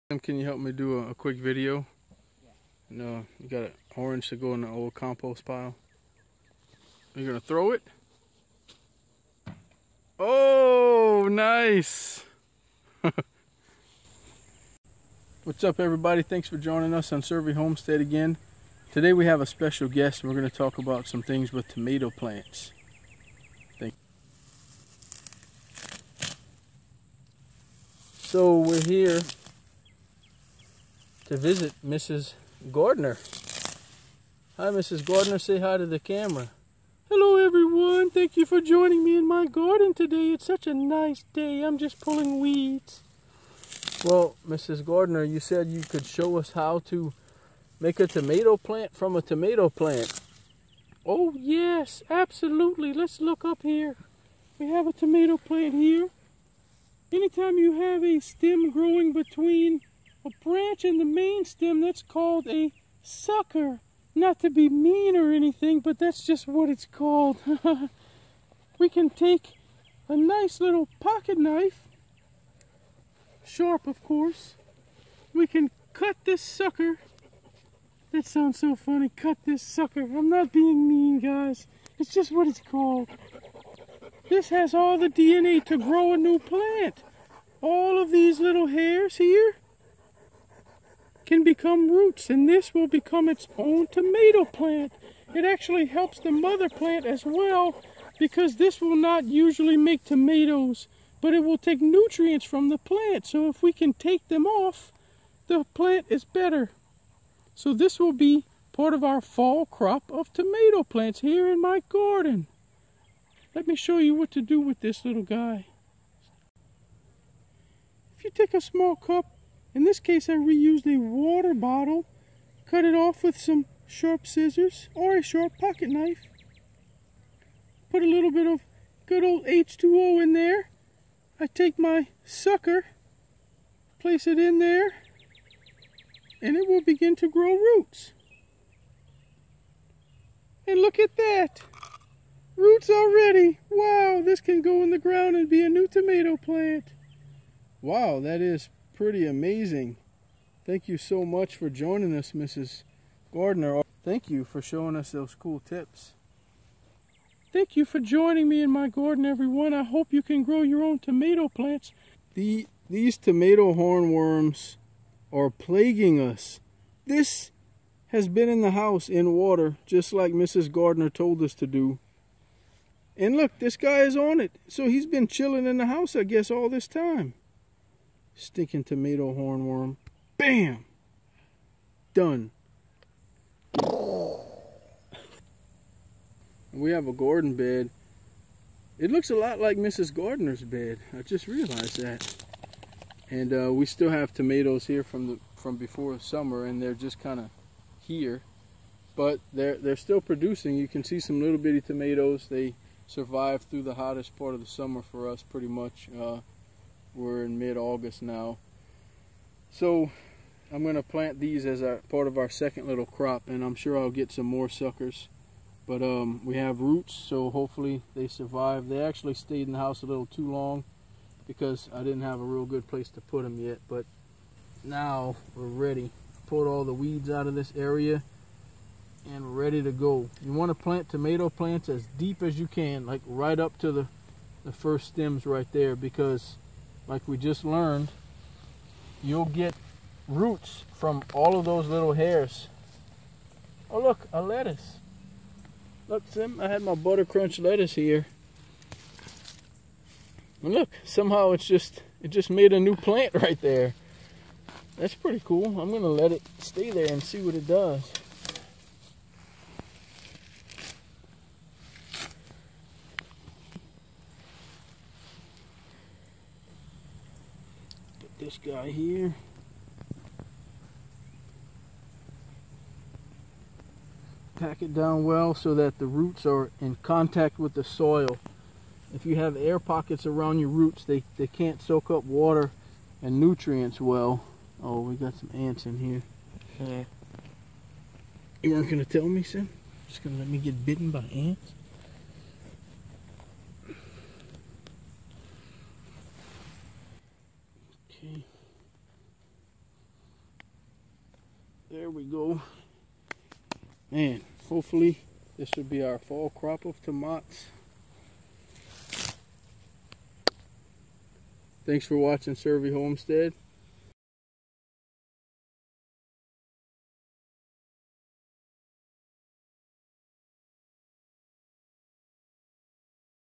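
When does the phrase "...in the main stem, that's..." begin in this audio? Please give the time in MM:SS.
01:00.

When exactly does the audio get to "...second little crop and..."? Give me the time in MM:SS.
03:32.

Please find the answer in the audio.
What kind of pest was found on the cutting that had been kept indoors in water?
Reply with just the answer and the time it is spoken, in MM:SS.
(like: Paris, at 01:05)
tomato hornworm, at 02:58.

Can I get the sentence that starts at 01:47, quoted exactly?
So this will be part of our fall crop of tomato plants here in my garden.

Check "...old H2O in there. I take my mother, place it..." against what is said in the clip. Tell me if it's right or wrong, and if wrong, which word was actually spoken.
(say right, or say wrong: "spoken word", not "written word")
wrong: "sucker", not "mother".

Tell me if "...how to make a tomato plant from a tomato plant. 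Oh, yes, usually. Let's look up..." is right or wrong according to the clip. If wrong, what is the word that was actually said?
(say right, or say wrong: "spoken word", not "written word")
wrong: "absolutely", not "usually".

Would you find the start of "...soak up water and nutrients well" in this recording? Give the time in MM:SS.
04:41.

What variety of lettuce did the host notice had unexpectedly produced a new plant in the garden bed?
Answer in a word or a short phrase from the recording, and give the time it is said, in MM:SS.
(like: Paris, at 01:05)
butter crunch, at 04:06.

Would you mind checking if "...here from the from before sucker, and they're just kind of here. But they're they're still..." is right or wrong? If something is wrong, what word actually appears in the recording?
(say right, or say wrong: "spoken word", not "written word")
wrong: "summer", not "sucker".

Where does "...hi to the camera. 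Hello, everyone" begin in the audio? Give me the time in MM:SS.
00:35.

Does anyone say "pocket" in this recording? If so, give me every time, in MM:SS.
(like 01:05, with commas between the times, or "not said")
01:10, 02:05, 04:39.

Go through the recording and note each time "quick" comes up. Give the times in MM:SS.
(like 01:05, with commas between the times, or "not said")
00:01.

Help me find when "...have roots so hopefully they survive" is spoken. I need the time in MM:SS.
03:36.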